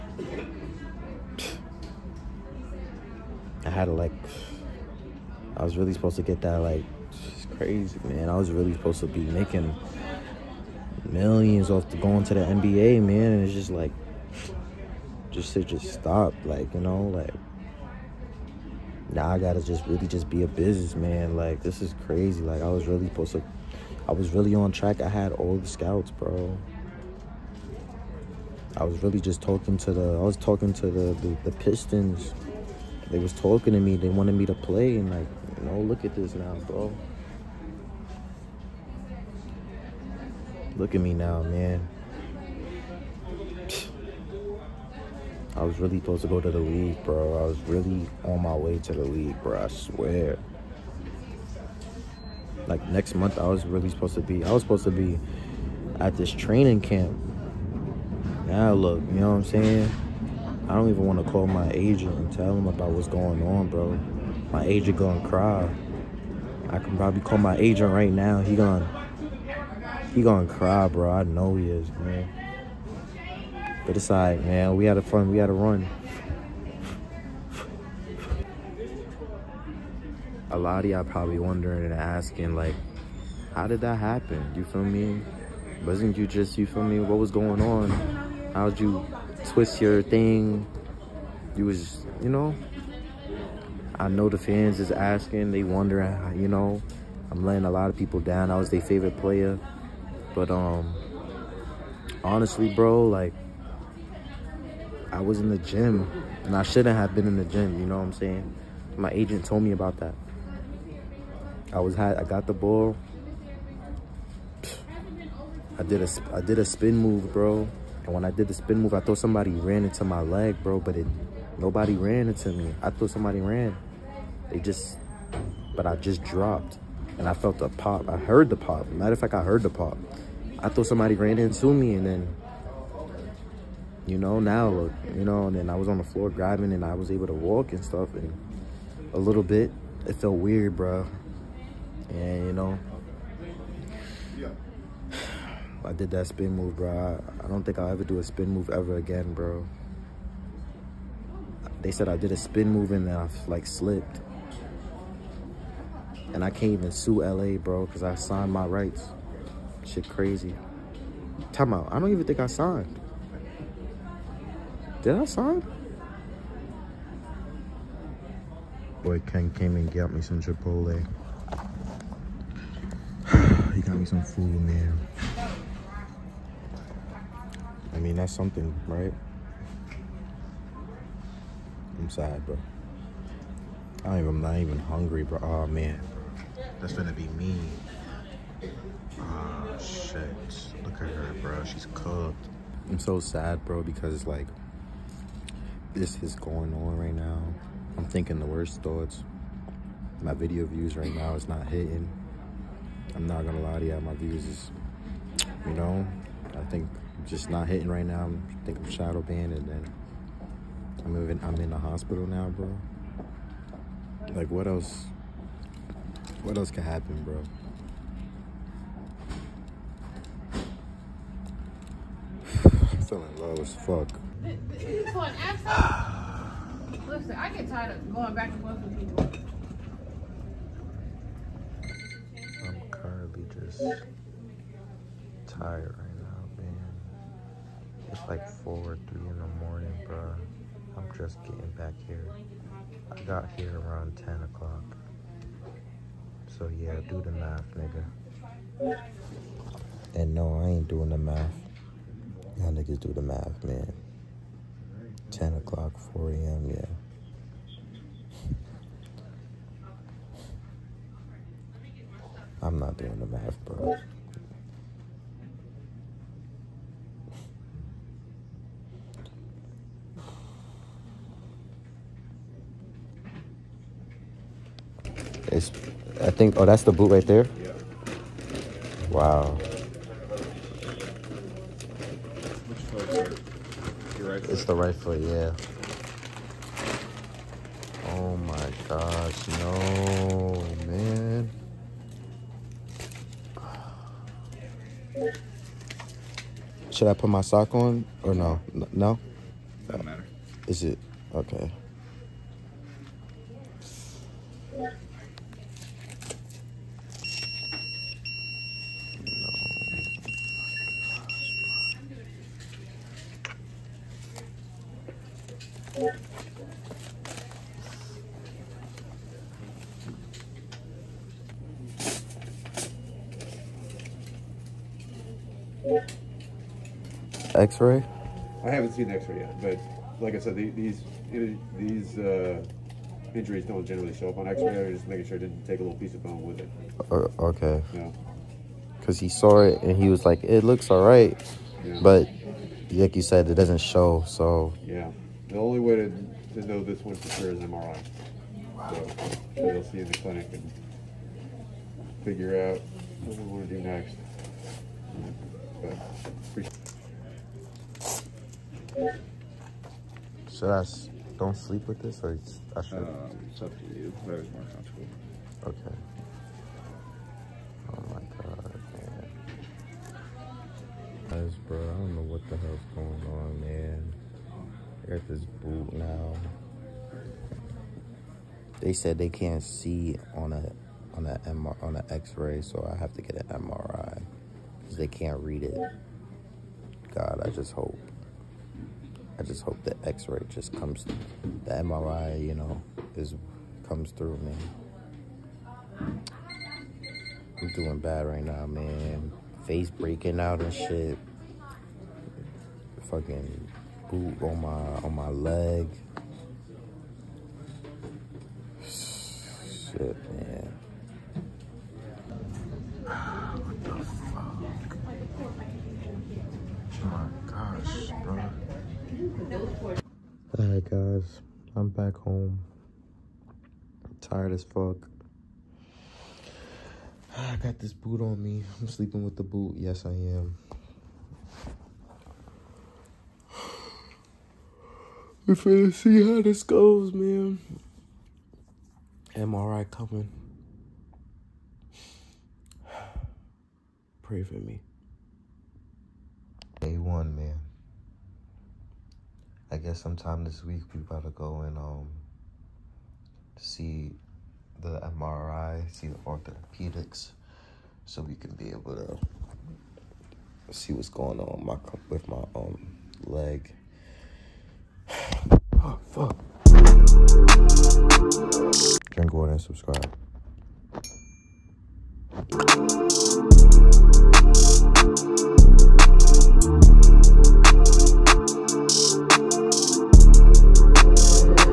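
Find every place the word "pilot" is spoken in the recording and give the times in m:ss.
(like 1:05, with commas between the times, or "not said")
not said.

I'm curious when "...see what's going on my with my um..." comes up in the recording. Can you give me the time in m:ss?
7:40.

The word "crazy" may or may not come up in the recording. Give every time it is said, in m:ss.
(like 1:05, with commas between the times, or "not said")
0:07, 0:22, 2:40.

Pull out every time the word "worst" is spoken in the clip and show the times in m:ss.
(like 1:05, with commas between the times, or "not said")
3:18.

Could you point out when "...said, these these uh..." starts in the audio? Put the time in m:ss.
5:30.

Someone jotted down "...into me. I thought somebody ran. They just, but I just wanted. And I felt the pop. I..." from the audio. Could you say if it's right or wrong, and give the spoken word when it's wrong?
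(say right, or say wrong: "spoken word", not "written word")
wrong: "dropped", not "wanted".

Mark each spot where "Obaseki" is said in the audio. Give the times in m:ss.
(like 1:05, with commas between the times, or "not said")
not said.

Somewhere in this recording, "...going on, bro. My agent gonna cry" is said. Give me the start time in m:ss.
1:03.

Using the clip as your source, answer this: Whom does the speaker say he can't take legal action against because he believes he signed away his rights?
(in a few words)
LA.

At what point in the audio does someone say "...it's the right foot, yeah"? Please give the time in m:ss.
4:44.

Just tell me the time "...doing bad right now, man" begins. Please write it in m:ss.
6:37.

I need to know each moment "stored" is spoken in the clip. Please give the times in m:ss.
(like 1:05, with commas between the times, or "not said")
not said.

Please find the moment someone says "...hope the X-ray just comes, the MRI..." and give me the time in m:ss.
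6:29.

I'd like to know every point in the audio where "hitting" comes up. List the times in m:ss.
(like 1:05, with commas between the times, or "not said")
3:21, 3:27.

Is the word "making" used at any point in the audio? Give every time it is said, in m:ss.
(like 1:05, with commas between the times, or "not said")
0:09, 5:35.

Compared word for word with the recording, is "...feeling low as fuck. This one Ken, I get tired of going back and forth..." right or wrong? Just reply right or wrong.
wrong.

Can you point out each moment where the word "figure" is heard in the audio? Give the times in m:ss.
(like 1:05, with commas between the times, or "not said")
5:52.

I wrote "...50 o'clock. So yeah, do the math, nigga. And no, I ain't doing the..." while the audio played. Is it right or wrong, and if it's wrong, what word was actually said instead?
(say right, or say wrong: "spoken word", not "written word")
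wrong: "10", not "50".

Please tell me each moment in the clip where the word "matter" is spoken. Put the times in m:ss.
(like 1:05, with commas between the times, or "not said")
2:08, 5:00.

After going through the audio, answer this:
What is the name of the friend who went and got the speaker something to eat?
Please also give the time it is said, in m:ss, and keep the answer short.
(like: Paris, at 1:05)
Ken, at 2:49.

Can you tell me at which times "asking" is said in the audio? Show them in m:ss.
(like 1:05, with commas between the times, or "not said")
1:21, 1:34.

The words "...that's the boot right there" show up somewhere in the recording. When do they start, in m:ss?
4:36.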